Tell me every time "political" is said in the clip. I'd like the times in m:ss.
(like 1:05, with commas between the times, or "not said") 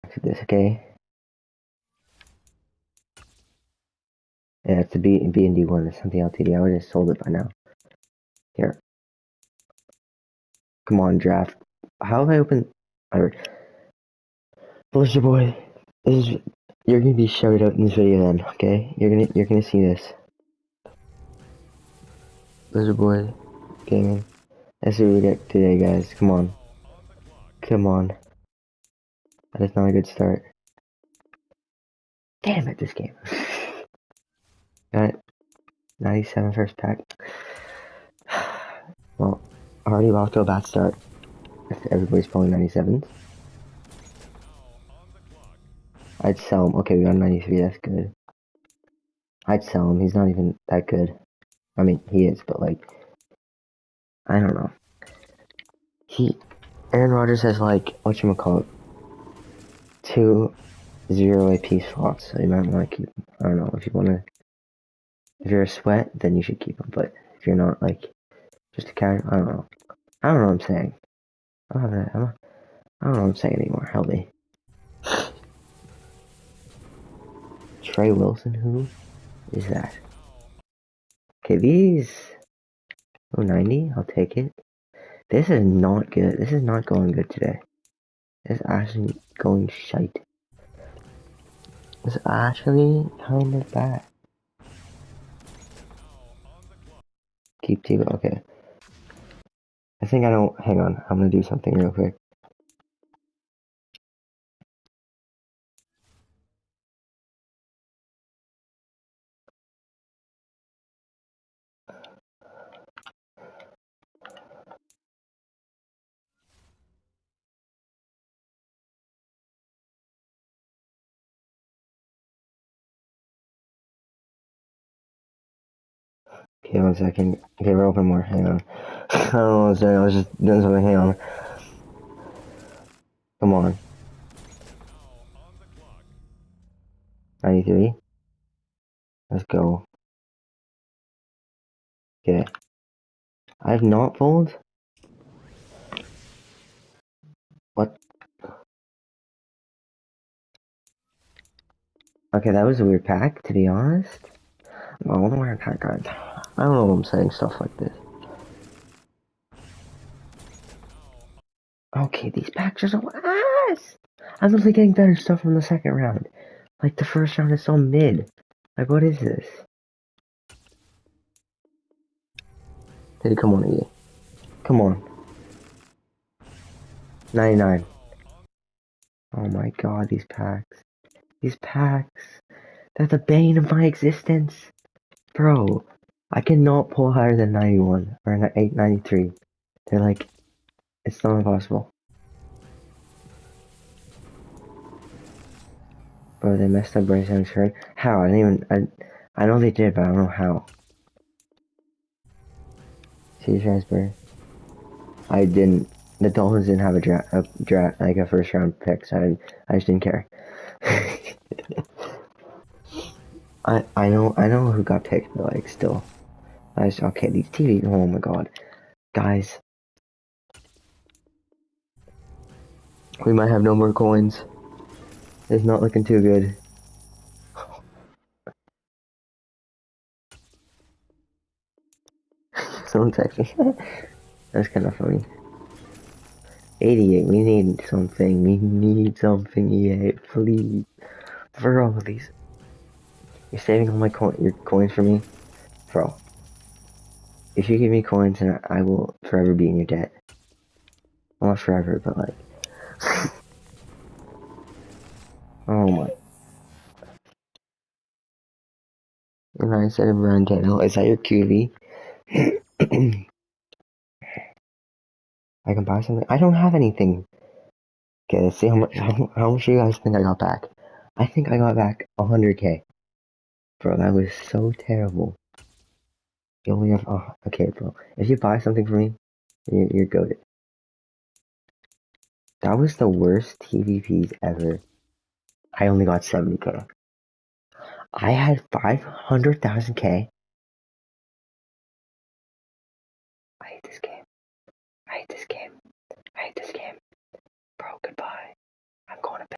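not said.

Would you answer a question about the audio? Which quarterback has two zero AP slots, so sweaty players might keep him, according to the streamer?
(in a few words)
Aaron Rodgers.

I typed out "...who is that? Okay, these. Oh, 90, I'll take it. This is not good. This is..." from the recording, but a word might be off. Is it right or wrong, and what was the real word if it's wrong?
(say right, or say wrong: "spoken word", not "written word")
right.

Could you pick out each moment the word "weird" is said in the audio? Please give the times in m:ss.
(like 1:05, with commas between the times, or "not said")
2:32.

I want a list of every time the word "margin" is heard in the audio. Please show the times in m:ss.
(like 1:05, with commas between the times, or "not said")
not said.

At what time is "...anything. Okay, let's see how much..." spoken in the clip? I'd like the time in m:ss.
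4:26.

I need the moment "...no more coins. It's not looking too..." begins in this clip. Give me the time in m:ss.
3:43.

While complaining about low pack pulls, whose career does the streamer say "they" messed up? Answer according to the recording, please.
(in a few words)
Bryce Young.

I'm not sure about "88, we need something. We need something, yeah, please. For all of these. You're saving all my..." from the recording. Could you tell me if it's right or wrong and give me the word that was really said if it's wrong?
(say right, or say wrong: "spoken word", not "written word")
right.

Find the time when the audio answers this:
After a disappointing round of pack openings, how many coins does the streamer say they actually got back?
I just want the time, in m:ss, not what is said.
4:46.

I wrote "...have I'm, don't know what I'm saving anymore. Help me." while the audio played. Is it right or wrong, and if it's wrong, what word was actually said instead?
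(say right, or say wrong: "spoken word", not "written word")
wrong: "saying", not "saving".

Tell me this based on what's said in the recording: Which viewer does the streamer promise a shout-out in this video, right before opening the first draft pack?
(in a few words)
Blizzard boy.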